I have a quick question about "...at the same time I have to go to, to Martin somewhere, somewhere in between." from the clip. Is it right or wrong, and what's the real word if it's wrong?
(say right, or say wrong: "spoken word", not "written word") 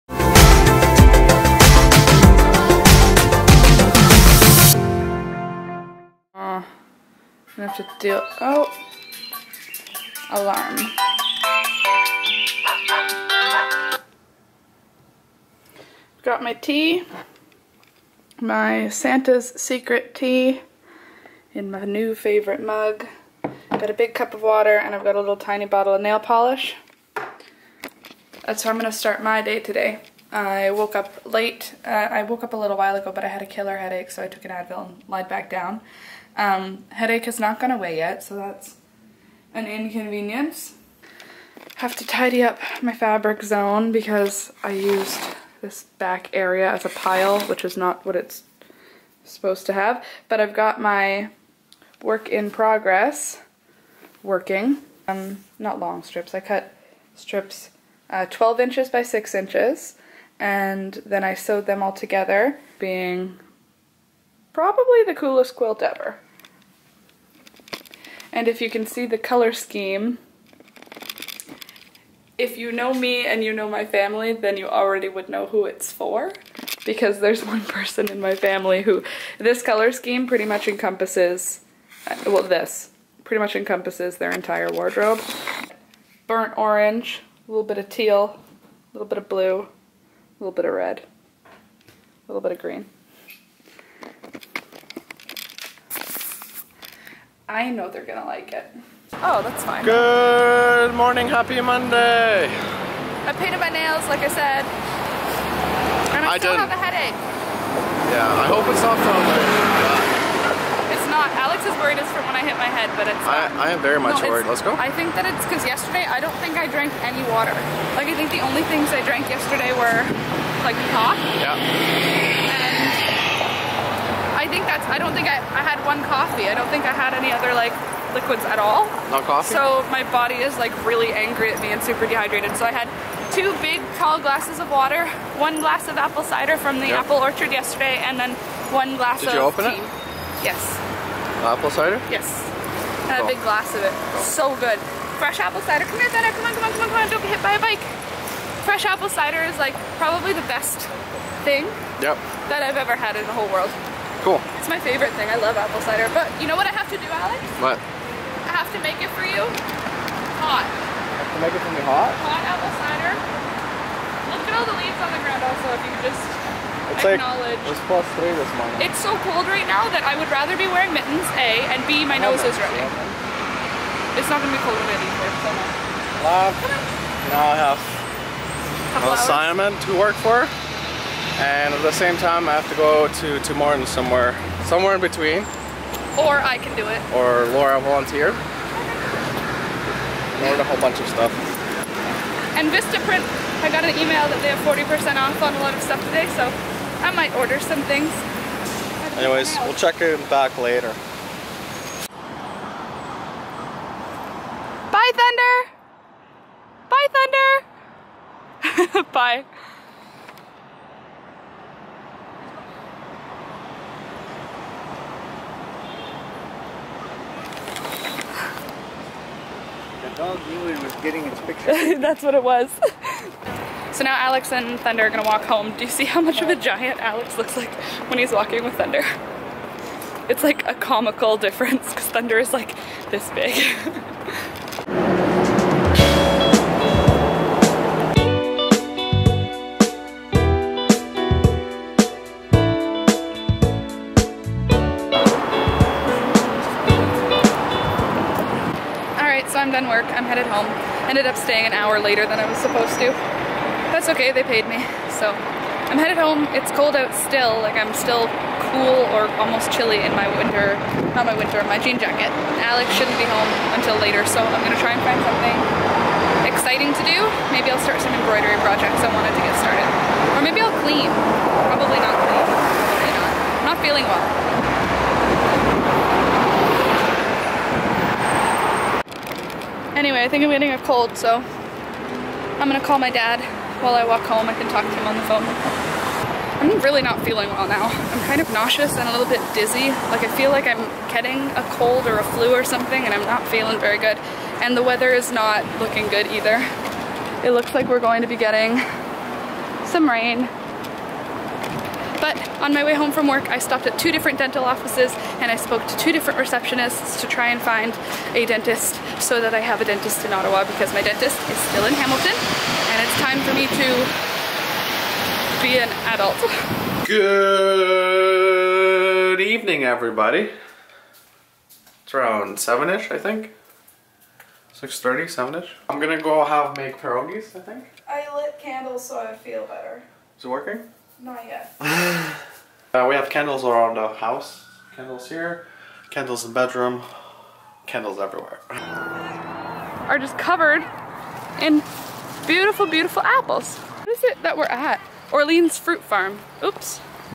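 right.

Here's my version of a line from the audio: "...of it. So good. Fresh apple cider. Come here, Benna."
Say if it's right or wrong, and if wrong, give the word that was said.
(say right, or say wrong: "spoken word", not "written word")
right.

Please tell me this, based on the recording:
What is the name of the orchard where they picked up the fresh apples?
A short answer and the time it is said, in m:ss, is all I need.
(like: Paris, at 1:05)
Orleans Fruit Farm, at 5:45.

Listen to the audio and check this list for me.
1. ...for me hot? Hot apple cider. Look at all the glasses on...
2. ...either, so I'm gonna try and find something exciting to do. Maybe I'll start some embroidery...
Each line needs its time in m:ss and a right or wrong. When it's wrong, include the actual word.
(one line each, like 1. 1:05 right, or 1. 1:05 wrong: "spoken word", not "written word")
1. 2:41 wrong: "leaves", not "glasses"
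2. 4:23 wrong: "later", not "either".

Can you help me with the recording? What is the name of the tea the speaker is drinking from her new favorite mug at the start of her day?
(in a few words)
Santa's Secret.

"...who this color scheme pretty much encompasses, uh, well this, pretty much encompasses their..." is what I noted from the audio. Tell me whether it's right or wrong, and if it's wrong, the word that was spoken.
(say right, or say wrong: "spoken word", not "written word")
right.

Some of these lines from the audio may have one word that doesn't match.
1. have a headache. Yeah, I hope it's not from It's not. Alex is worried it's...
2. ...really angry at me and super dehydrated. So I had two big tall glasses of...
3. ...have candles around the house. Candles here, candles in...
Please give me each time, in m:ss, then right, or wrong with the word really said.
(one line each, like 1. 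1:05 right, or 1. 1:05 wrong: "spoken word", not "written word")
1. 1:46 right
2. 2:10 right
3. 5:33 right.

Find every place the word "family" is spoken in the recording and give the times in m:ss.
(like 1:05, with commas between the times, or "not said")
1:13, 1:18.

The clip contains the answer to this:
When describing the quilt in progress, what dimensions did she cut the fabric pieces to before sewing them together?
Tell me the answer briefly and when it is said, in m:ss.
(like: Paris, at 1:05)
12 inches by 6 inches, at 0:58.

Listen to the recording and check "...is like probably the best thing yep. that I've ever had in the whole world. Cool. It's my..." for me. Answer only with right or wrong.
right.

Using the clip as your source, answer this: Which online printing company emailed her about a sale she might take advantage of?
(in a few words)
Vistaprint.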